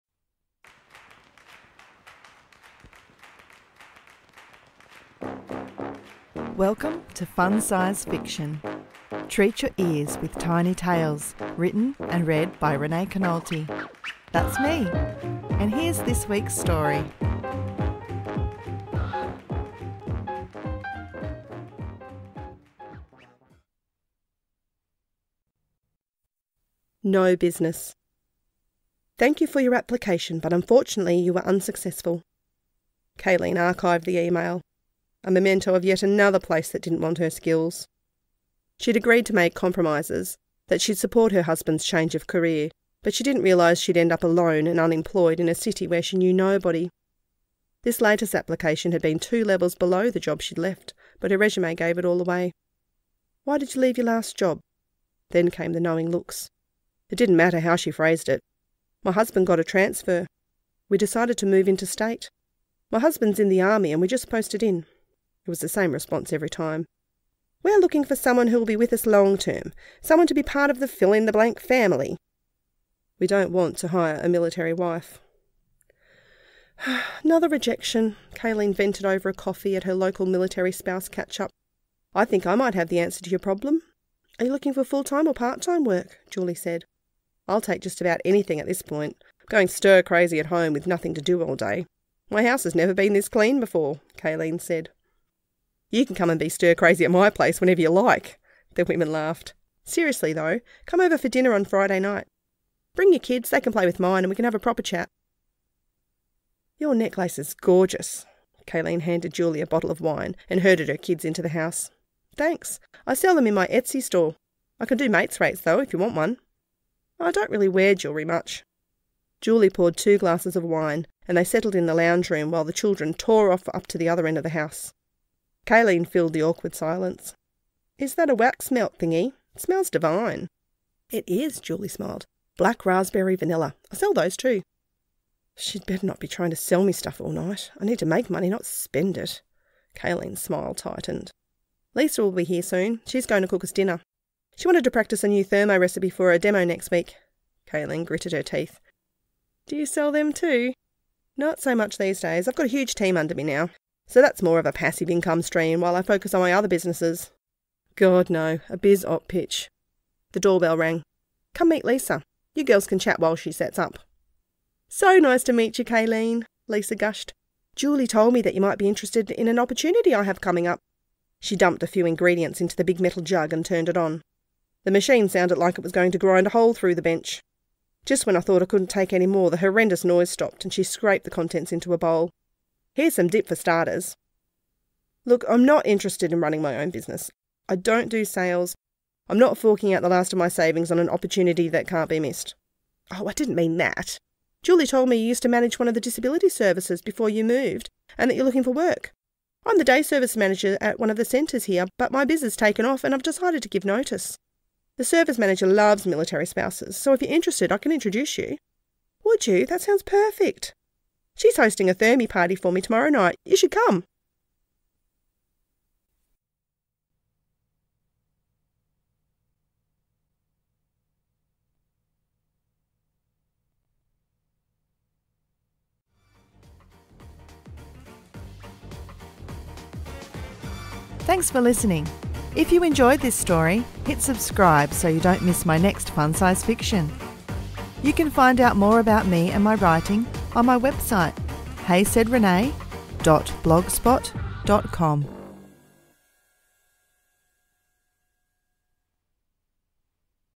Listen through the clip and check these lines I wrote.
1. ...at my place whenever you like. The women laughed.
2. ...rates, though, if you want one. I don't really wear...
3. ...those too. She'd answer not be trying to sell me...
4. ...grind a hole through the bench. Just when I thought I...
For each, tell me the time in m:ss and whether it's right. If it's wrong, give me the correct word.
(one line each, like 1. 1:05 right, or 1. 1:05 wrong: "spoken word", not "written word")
1. 1:37 right
2. 1:55 right
3. 2:14 wrong: "better", not "answer"
4. 2:56 right.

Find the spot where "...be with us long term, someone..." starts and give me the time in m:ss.
1:08.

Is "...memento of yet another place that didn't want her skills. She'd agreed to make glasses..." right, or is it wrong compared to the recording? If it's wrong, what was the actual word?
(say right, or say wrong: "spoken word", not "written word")
wrong: "compromises", not "glasses".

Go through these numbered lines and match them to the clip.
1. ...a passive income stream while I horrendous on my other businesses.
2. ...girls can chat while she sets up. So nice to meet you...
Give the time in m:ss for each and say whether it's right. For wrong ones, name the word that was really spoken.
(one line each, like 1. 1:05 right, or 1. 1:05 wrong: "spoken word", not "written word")
1. 2:34 wrong: "focus", not "horrendous"
2. 2:42 right.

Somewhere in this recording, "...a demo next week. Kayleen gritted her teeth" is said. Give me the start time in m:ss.
2:26.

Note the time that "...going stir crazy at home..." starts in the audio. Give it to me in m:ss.
1:29.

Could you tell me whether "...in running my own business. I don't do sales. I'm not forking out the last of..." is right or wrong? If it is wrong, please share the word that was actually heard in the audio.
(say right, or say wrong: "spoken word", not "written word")
right.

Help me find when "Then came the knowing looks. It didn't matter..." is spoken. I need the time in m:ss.
0:55.